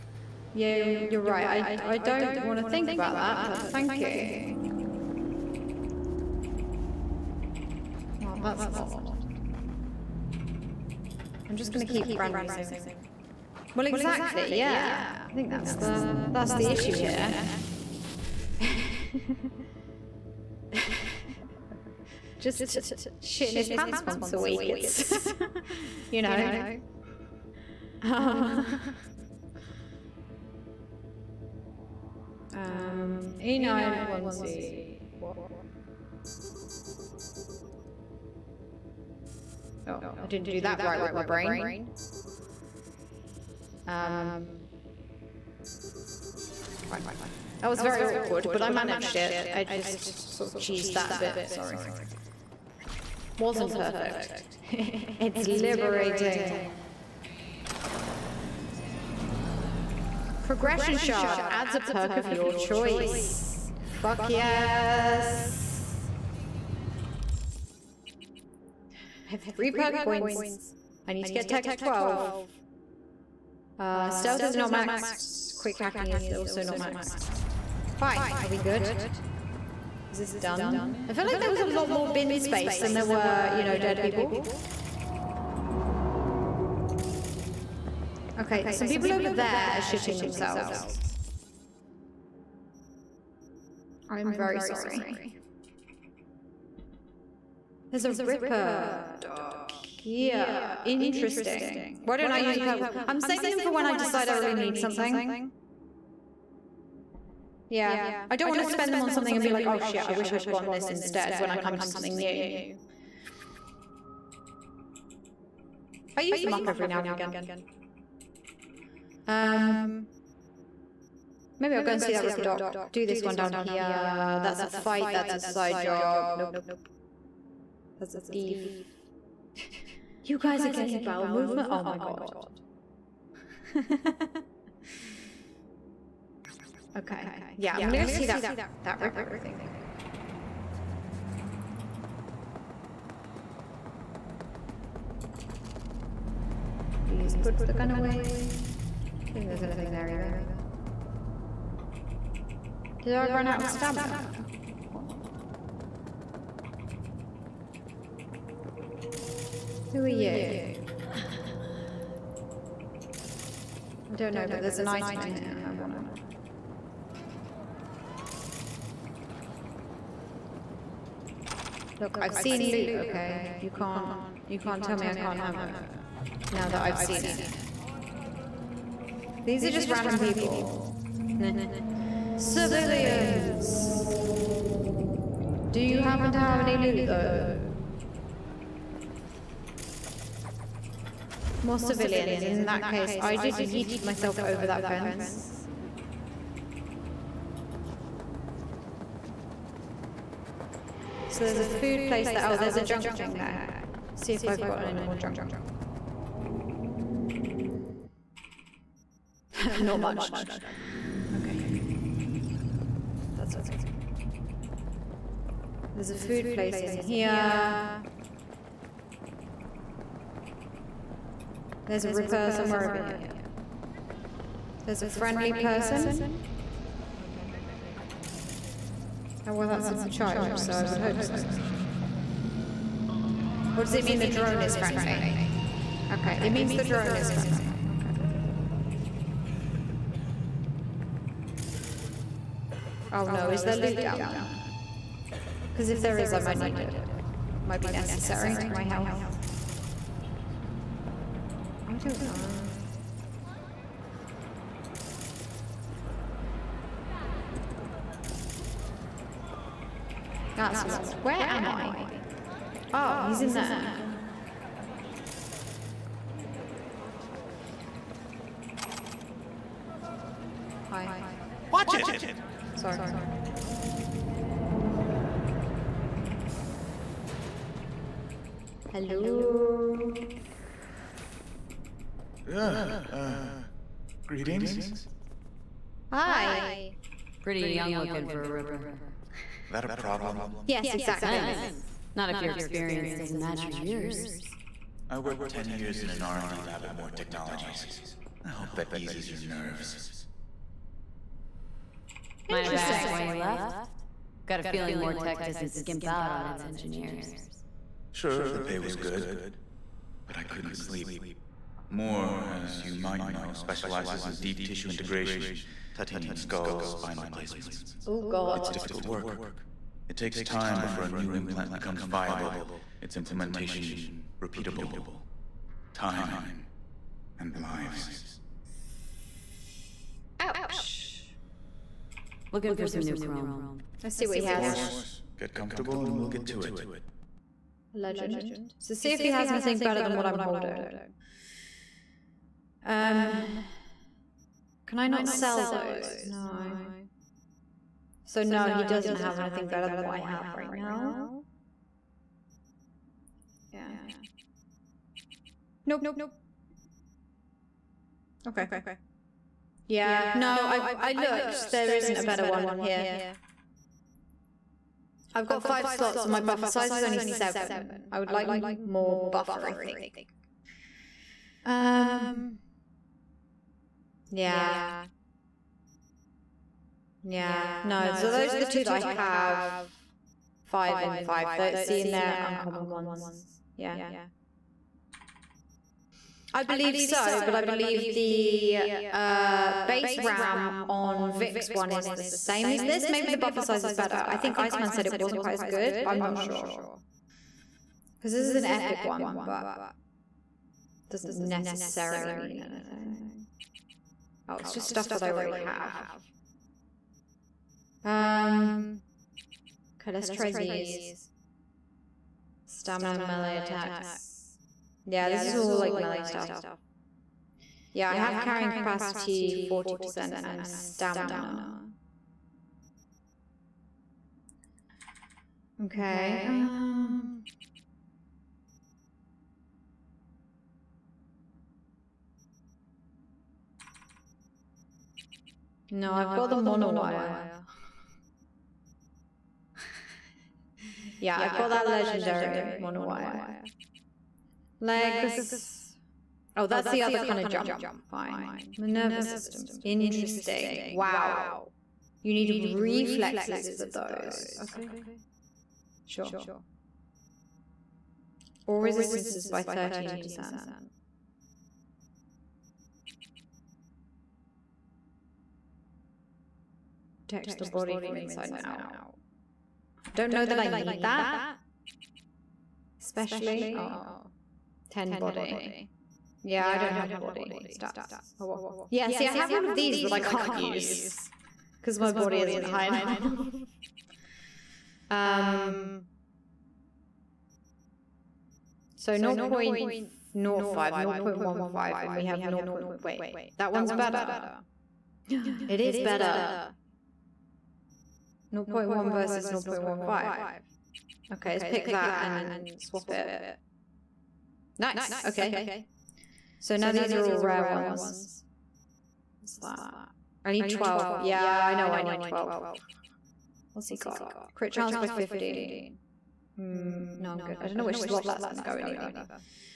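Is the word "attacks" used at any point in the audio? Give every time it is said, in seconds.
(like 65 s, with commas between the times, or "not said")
413 s.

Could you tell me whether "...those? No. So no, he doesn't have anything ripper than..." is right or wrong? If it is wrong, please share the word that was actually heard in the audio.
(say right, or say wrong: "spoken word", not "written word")
wrong: "better", not "ripper".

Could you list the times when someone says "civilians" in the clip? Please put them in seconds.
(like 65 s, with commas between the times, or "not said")
182 s, 191 s.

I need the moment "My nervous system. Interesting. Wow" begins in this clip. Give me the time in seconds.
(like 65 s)
448 s.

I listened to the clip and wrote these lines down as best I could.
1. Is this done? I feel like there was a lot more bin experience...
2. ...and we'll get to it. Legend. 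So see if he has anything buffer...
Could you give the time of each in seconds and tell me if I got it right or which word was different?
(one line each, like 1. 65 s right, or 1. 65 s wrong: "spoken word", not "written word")
1. 80 s wrong: "space", not "experience"
2. 336 s wrong: "better", not "buffer".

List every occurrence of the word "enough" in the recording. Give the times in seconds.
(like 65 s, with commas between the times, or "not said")
482 s.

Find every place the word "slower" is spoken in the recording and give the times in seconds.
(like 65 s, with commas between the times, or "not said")
not said.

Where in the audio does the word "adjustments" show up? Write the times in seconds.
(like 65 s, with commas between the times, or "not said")
not said.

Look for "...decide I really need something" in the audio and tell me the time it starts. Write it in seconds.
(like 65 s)
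103 s.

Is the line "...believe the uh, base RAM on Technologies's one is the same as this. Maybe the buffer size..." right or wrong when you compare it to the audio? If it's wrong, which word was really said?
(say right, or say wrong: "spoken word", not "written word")
wrong: "Vik", not "Technologies".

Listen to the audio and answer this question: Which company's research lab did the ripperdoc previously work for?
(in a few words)
Moore Technologies.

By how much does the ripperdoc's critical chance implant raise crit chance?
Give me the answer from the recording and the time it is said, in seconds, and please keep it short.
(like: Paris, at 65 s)
15, at 515 s.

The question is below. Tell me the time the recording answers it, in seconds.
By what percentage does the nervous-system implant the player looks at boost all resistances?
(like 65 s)
459 s.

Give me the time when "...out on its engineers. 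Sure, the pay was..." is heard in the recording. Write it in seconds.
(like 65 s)
306 s.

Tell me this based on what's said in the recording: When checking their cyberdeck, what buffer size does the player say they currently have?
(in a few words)
7.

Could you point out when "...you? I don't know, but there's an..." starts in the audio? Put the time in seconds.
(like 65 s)
160 s.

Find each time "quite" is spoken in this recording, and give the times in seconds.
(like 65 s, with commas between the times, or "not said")
395 s.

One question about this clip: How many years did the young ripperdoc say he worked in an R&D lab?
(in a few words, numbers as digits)
10.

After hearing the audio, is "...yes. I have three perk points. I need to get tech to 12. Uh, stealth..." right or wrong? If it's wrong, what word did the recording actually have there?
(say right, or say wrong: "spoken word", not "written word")
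right.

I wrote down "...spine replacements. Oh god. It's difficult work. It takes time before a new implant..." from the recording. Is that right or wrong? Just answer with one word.
right.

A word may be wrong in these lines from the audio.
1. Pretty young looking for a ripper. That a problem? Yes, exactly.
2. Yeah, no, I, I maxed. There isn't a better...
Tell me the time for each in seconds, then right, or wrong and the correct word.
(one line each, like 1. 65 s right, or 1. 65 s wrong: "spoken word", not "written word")
1. 287 s right
2. 359 s wrong: "looked", not "maxed".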